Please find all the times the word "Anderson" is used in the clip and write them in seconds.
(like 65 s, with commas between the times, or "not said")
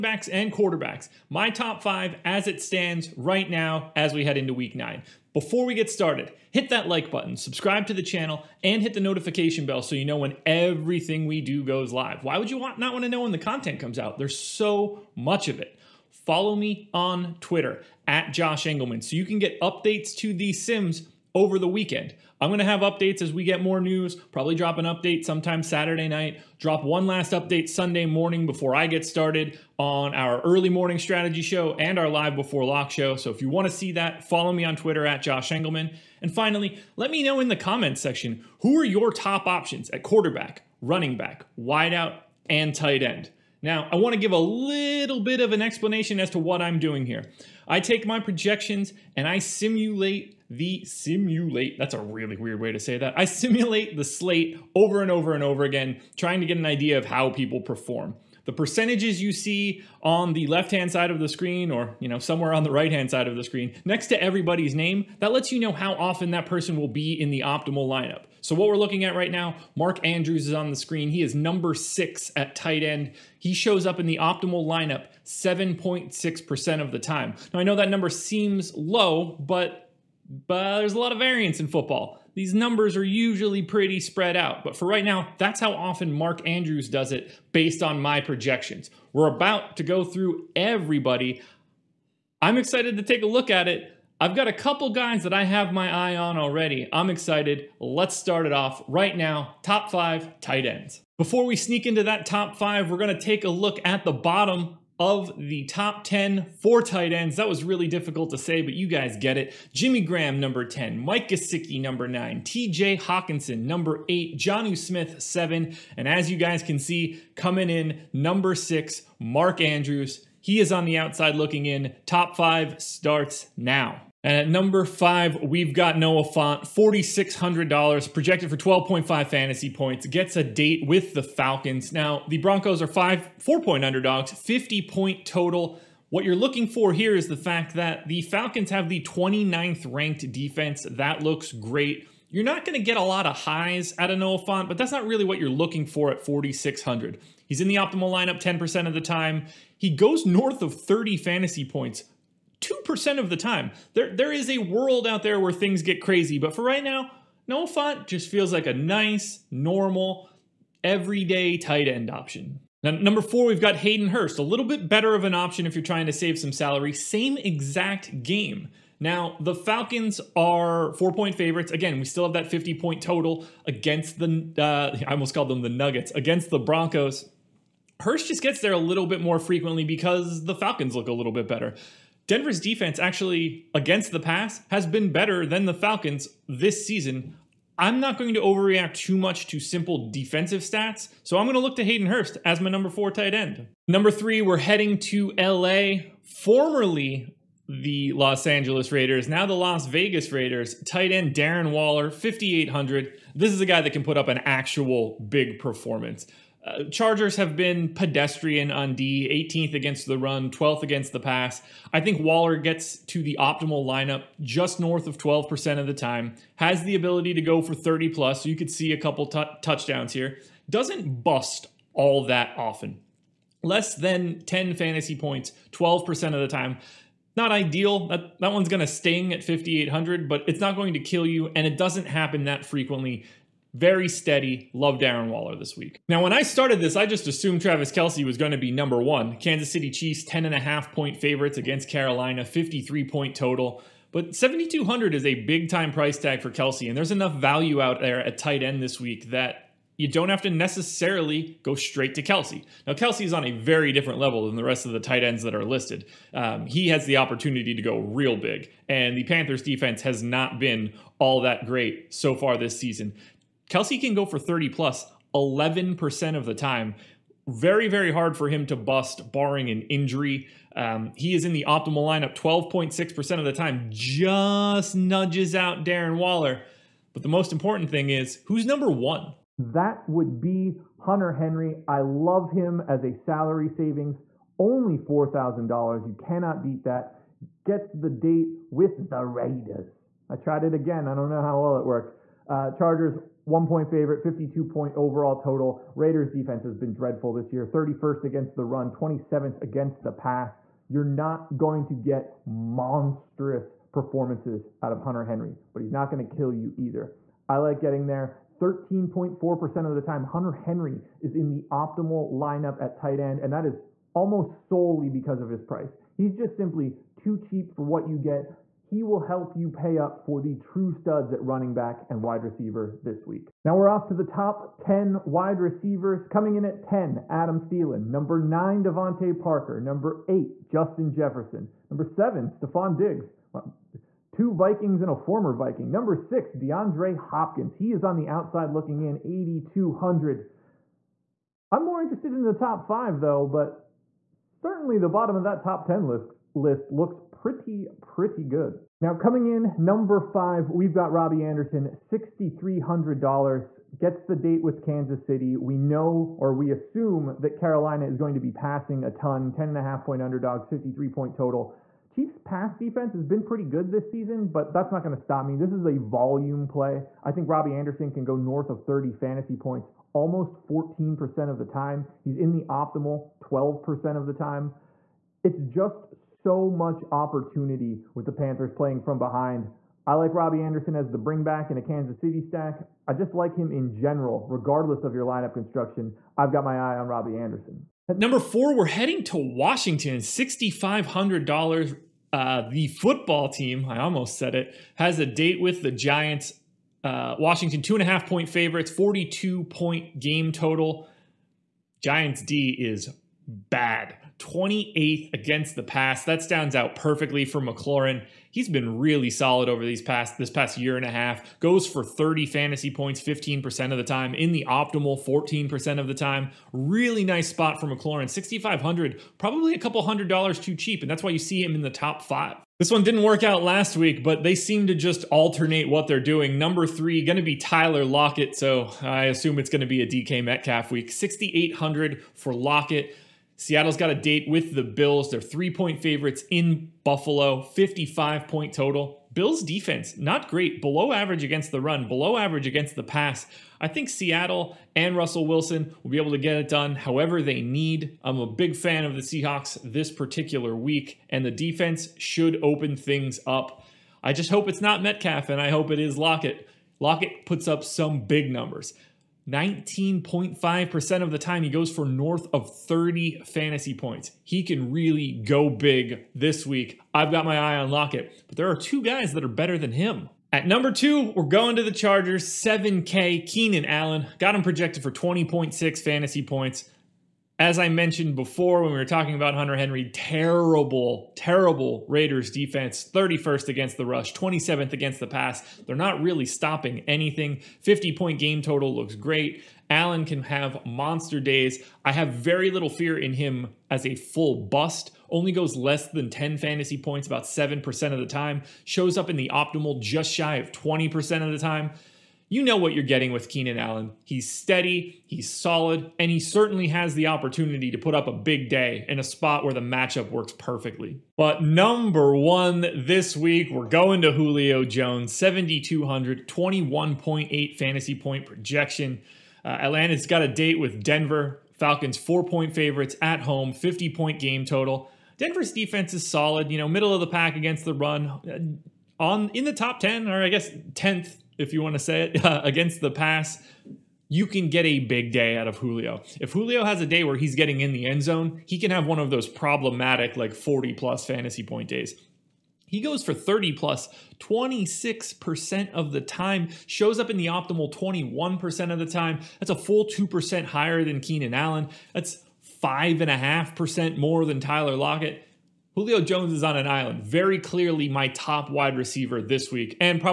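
351 s, 367 s, 380 s, 387 s.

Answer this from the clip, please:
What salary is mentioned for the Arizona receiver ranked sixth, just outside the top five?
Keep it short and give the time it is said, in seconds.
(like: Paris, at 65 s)
8,200, at 339 s.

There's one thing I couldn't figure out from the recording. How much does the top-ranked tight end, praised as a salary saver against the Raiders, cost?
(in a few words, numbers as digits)
$4,000.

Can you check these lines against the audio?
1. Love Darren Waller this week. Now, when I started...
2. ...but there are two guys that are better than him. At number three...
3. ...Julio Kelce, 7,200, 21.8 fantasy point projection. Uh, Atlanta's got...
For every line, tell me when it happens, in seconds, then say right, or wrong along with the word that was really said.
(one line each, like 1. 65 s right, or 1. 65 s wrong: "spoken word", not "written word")
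1. 234 s right
2. 468 s wrong: "two", not "three"
3. 514 s wrong: "Jones", not "Kelce".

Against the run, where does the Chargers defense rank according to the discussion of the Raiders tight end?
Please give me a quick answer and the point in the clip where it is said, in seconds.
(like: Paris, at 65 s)
18th, at 209 s.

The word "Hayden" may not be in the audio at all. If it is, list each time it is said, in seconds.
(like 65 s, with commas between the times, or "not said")
163 s, 191 s.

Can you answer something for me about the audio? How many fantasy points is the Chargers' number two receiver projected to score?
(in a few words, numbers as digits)
20.6.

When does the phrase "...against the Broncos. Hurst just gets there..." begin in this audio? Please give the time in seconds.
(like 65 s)
176 s.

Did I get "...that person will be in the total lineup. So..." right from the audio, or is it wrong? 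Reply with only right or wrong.
wrong.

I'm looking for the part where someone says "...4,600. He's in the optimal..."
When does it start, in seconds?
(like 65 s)
146 s.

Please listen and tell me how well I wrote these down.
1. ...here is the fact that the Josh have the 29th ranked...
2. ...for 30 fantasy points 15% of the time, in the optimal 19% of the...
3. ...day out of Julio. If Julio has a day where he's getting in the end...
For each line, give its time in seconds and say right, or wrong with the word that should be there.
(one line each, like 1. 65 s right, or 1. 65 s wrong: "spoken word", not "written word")
1. 136 s wrong: "Falcons", not "Josh"
2. 411 s wrong: "14", not "19"
3. 535 s right.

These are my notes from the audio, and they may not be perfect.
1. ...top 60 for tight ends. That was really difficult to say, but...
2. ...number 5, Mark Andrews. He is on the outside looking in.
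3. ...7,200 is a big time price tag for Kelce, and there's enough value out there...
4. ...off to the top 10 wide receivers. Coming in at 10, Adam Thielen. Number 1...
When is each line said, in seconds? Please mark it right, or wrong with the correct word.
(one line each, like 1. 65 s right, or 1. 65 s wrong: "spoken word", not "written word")
1. 105 s wrong: "10", not "60"
2. 118 s wrong: "6", not "5"
3. 244 s right
4. 323 s wrong: "9", not "1".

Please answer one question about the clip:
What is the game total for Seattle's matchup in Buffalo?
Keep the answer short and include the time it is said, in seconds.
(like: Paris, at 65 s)
55, at 437 s.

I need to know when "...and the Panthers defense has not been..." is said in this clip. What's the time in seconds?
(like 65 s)
258 s.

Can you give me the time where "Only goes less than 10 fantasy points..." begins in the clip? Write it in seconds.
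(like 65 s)
495 s.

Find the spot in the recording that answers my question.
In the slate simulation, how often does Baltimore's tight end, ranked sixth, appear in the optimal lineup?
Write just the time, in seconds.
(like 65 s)
75 s.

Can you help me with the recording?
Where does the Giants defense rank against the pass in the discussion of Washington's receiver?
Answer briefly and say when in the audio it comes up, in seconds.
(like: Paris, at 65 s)
28th, at 404 s.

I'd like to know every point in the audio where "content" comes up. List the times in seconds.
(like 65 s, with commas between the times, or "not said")
13 s.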